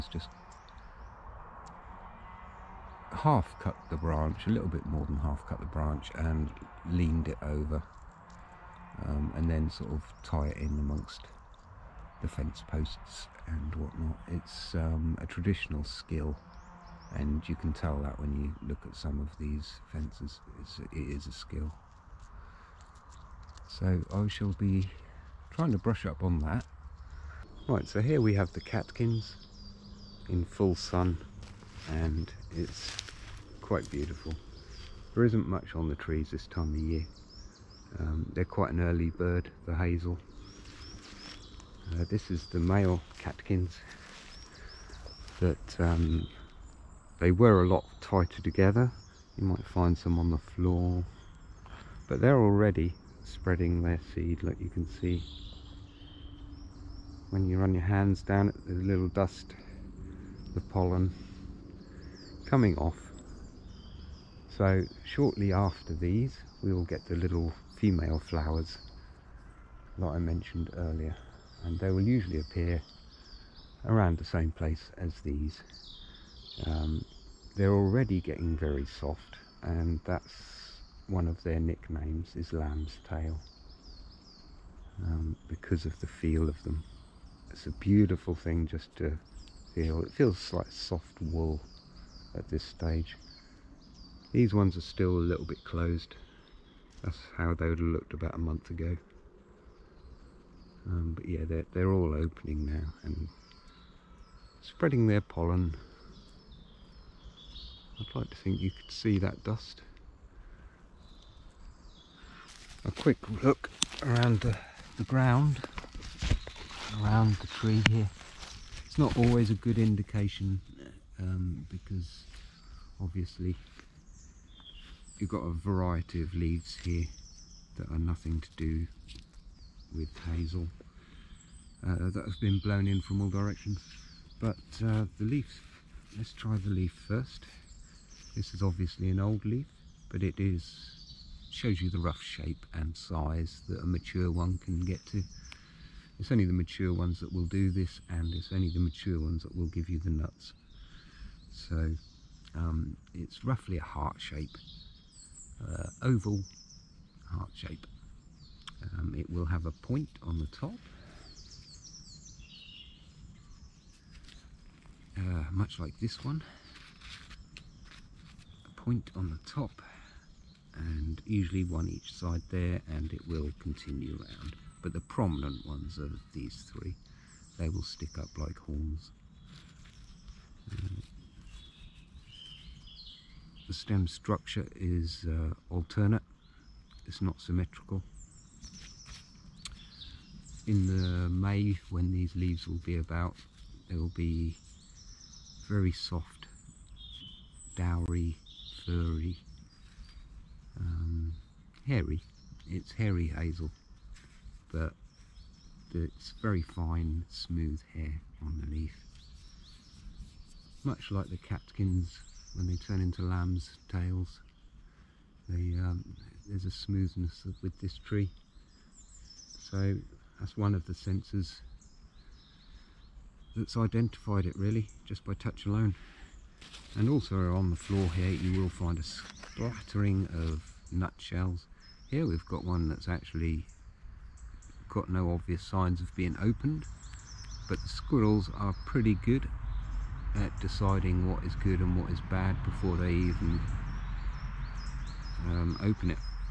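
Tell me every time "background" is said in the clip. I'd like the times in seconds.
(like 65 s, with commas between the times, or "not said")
not said.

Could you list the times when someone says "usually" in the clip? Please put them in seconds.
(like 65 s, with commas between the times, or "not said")
72 s, 171 s.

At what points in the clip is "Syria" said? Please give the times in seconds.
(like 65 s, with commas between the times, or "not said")
not said.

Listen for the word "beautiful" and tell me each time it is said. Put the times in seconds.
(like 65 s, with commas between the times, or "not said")
33 s, 87 s.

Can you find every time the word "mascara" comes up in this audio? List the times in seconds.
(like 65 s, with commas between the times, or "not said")
not said.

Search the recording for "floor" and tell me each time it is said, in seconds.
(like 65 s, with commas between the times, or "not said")
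50 s, 227 s.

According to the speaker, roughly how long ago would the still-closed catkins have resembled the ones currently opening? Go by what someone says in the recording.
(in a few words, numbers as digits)
a month.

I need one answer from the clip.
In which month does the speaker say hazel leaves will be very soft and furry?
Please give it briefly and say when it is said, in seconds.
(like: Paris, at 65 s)
May, at 191 s.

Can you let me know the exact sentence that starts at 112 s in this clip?
A quick look around the, the ground, around the tree here.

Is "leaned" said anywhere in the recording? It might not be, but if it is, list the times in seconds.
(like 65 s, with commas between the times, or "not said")
6 s.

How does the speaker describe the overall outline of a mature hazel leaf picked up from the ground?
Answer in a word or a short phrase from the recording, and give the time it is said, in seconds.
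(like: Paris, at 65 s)
oval heart shape, at 156 s.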